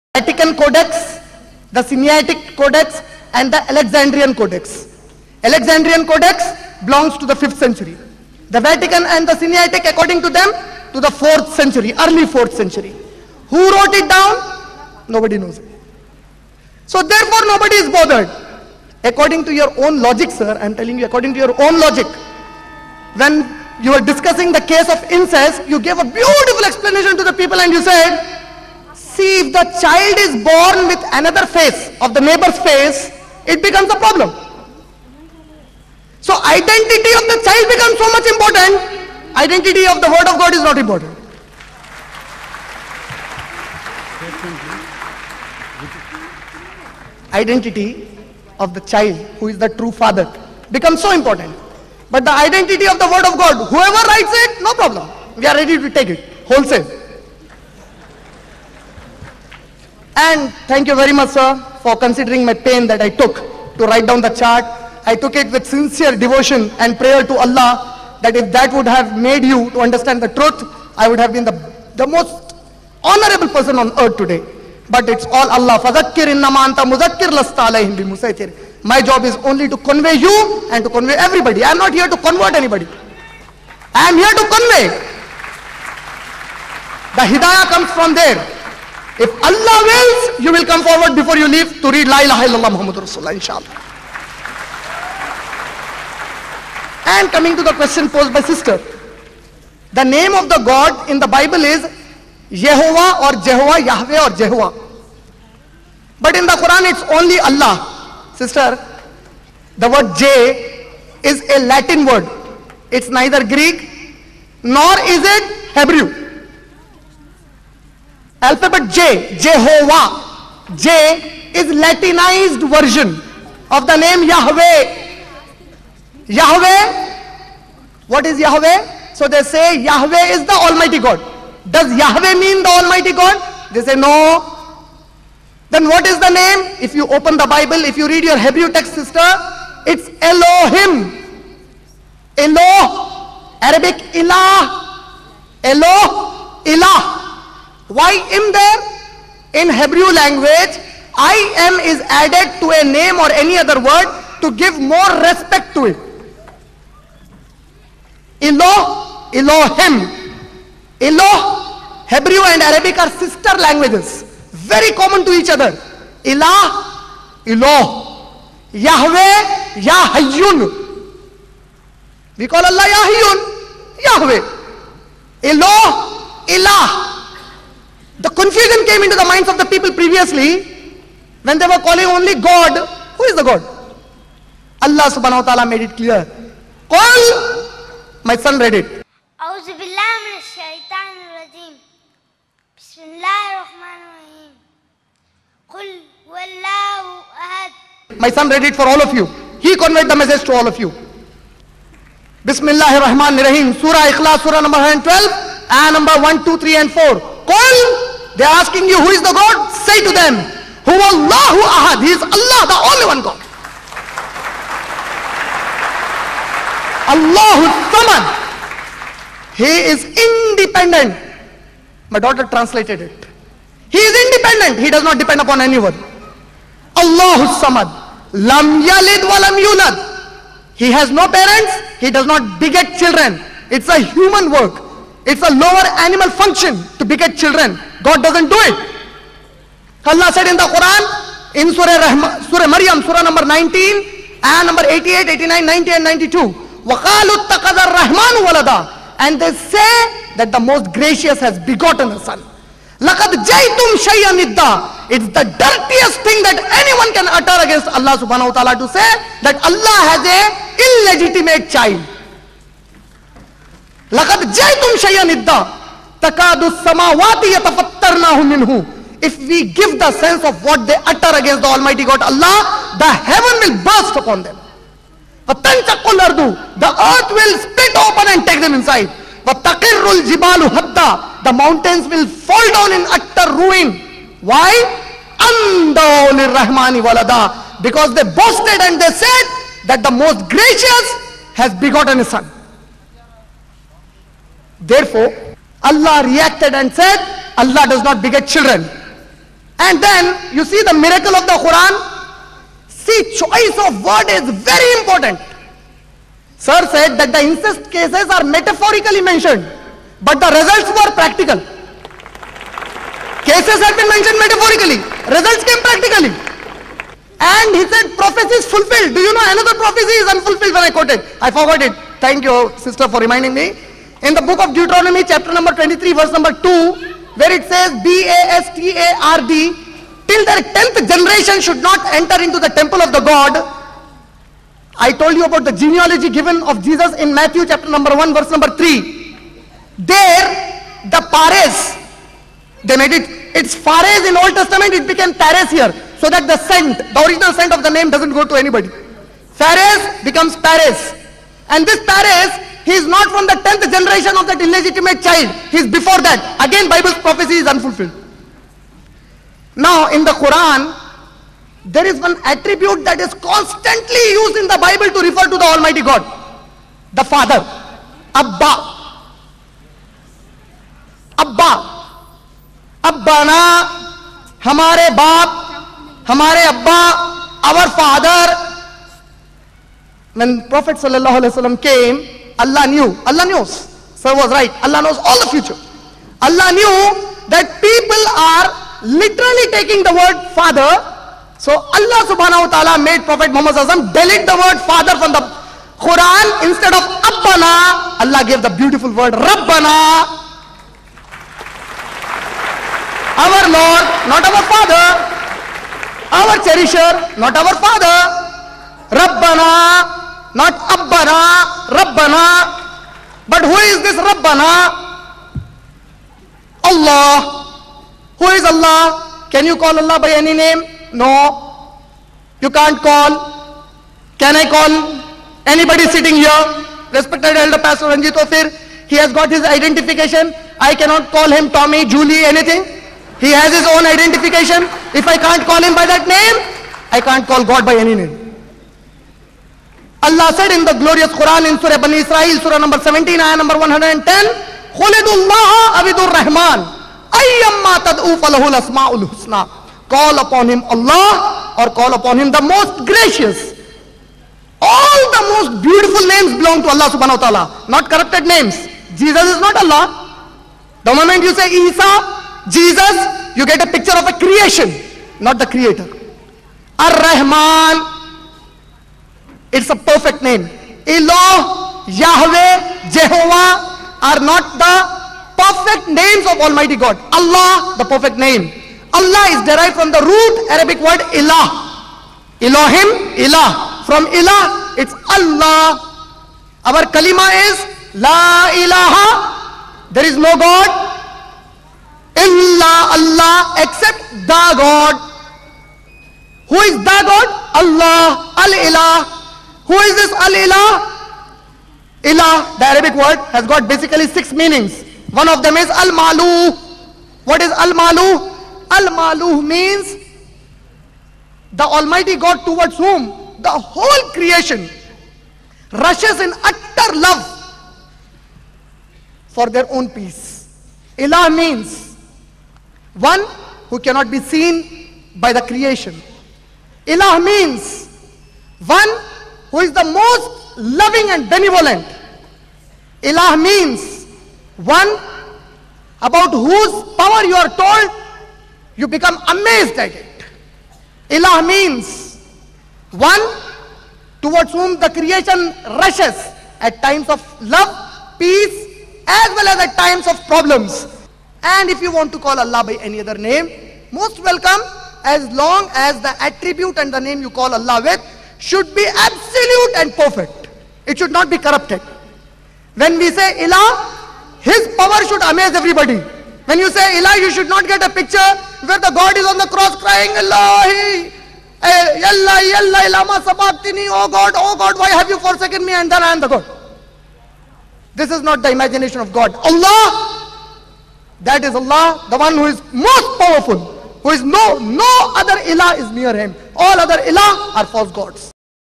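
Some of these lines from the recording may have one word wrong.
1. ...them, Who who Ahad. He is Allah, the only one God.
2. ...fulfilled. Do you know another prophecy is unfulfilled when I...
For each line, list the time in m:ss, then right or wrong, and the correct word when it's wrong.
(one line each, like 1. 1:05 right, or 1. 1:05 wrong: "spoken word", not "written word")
1. 3:30 right
2. 5:18 right.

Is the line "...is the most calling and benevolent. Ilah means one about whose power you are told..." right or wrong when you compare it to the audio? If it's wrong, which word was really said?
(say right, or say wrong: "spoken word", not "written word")
wrong: "loving", not "calling".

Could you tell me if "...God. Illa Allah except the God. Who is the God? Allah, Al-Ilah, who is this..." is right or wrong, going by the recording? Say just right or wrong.
right.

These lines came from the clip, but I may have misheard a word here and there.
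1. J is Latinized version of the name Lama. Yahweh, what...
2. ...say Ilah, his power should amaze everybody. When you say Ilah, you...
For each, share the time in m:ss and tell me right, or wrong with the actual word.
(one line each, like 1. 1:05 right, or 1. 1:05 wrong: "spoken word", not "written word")
1. 2:00 wrong: "Yahweh", not "Lama"
2. 9:23 right.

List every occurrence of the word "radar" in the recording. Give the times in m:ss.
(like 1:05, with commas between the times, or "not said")
not said.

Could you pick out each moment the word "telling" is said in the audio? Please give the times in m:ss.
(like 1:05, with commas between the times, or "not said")
0:20.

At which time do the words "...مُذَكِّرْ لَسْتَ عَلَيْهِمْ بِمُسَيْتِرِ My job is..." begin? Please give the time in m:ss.
1:16.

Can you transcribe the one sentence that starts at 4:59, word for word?
And then you see the miracle of the Quran.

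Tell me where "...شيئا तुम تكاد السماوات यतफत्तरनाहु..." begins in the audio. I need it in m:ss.
4:25.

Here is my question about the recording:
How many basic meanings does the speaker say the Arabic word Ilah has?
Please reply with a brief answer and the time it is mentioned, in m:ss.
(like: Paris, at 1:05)
6, at 8:24.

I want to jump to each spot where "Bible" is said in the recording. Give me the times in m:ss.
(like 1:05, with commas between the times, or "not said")
1:41, 2:17, 5:56, 6:04.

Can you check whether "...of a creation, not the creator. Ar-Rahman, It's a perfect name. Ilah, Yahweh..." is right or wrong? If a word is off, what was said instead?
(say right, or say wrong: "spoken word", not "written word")
right.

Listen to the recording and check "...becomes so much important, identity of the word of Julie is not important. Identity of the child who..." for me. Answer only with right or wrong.
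wrong.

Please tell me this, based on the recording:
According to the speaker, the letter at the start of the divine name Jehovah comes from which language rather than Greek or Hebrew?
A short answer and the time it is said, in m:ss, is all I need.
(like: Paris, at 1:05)
Latin, at 1:51.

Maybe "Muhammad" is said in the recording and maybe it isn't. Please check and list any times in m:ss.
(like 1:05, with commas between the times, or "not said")
1:32, 6:33.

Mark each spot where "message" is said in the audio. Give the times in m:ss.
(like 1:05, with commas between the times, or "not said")
3:20.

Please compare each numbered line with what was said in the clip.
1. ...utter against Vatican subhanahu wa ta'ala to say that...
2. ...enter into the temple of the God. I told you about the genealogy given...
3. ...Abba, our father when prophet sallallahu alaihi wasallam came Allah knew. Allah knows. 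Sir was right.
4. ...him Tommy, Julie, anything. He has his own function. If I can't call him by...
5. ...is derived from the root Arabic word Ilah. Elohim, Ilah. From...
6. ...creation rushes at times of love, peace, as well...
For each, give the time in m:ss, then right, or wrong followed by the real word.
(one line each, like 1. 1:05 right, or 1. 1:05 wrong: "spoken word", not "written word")
1. 4:17 wrong: "Allah", not "Vatican"
2. 5:32 right
3. 6:16 right
4. 7:11 wrong: "identification", not "function"
5. 7:59 right
6. 9:05 right.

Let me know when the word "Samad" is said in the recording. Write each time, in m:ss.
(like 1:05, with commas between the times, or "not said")
3:37, 3:47.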